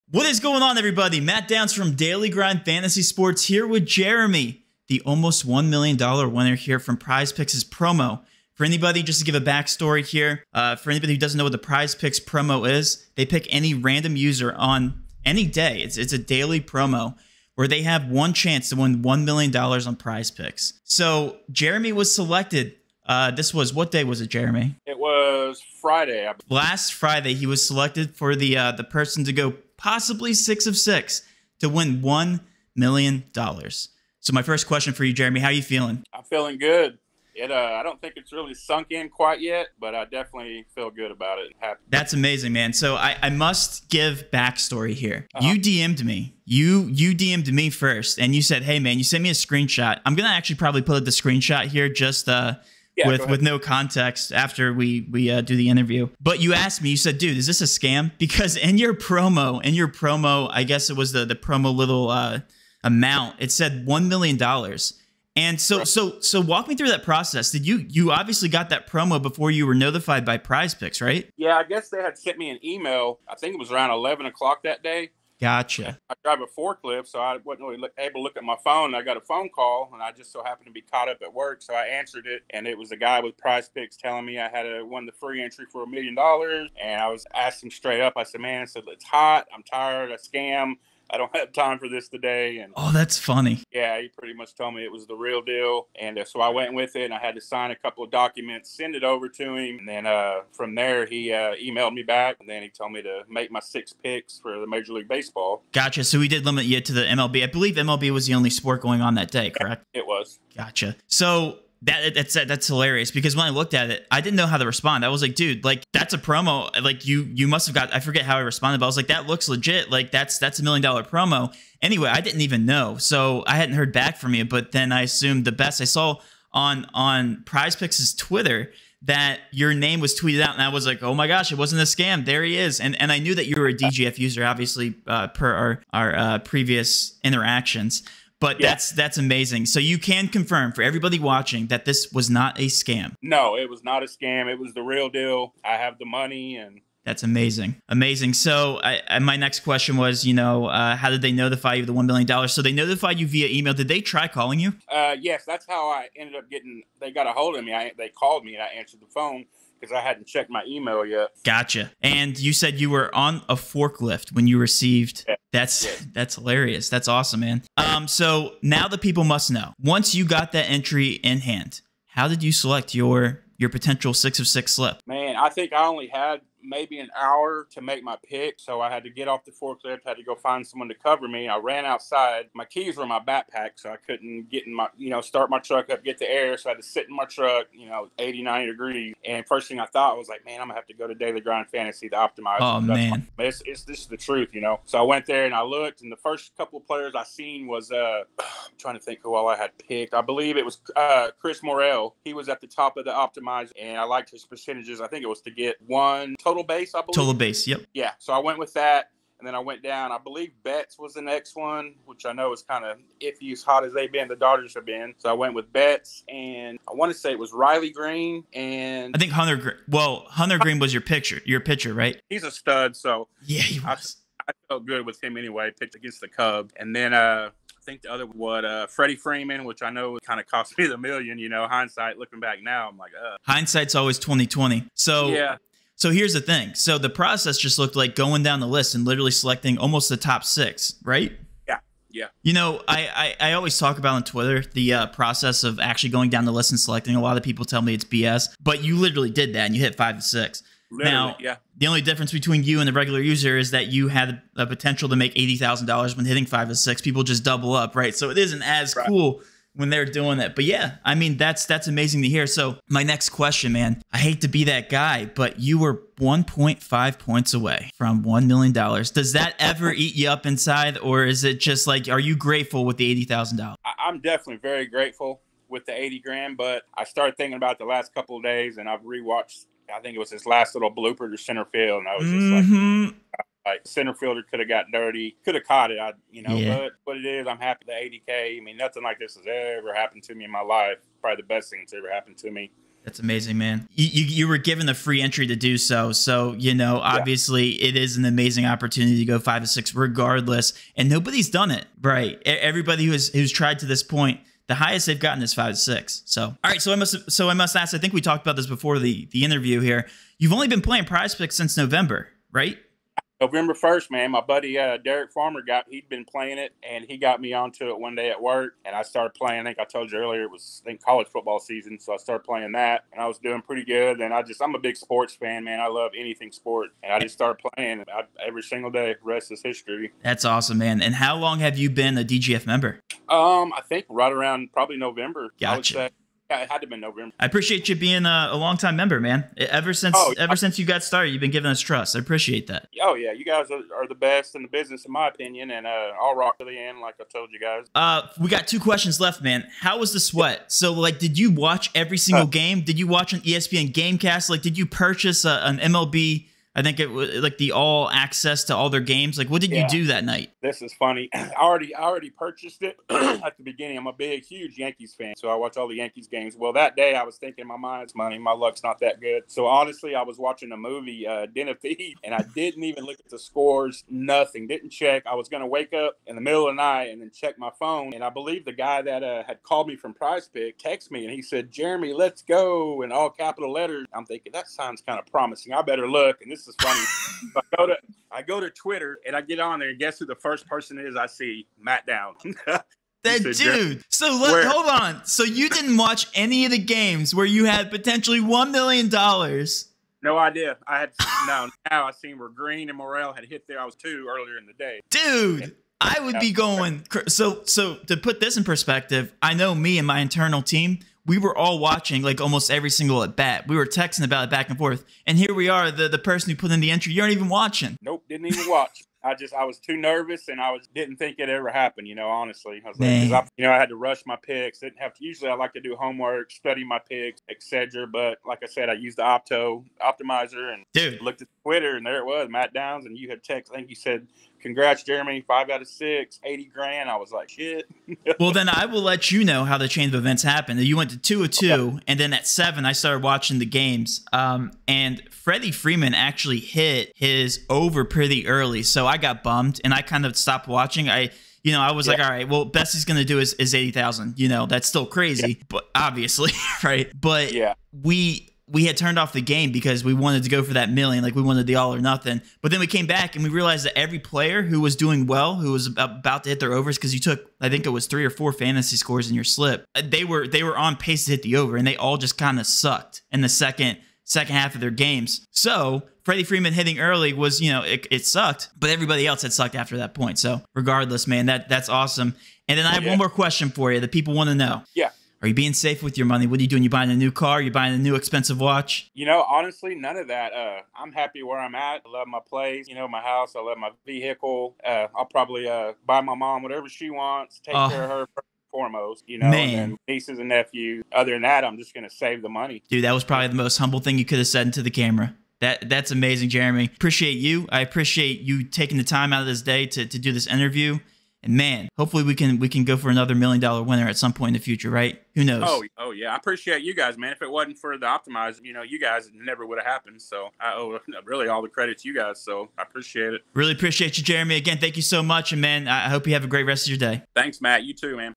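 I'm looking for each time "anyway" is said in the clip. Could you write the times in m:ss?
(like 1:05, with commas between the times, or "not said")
2:01, 3:45.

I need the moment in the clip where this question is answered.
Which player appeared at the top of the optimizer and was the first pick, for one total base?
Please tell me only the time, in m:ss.
3:21.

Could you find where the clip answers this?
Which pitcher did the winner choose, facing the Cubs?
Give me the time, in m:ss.
3:40.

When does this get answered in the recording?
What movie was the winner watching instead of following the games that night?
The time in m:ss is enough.
6:11.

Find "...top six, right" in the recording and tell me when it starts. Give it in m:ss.
4:00.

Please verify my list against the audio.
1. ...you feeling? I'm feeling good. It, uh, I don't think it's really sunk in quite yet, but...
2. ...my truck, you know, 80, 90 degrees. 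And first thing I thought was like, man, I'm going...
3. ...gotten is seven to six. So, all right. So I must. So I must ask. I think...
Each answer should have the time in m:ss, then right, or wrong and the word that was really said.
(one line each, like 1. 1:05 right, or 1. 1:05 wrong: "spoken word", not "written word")
1. 0:35 right
2. 3:07 right
3. 5:05 wrong: "five", not "seven".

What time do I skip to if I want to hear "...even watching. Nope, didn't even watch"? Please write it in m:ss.
6:57.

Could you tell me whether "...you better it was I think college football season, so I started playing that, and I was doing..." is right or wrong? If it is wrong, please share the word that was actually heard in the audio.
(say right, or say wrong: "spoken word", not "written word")
wrong: "earlier", not "better".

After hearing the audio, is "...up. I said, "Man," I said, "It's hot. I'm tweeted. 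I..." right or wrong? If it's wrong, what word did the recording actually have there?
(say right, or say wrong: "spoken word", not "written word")
wrong: "tired", not "tweeted".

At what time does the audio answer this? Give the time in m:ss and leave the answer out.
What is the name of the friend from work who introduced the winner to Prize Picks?
5:14.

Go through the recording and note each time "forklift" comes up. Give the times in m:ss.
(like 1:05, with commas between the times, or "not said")
1:16, 2:43, 2:59.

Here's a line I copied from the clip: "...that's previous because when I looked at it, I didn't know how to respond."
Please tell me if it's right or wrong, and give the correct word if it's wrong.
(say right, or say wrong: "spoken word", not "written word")
wrong: "hilarious", not "previous".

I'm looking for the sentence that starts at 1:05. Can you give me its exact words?
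And so, so, so, walk me through that process.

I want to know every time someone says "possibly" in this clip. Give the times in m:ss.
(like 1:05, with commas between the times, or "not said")
0:29.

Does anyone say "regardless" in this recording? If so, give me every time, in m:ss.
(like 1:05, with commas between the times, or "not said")
4:59, 8:00.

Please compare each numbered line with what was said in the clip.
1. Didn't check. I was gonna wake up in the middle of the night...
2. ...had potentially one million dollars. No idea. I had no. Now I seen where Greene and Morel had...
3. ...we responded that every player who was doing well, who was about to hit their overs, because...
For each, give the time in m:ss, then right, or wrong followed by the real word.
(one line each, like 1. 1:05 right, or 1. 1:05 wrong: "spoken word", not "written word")
1. 6:14 right
2. 6:37 right
3. 7:43 wrong: "realized", not "responded".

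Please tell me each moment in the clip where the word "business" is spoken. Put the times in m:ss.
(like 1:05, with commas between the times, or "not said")
5:44.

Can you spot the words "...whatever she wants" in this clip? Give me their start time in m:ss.
8:16.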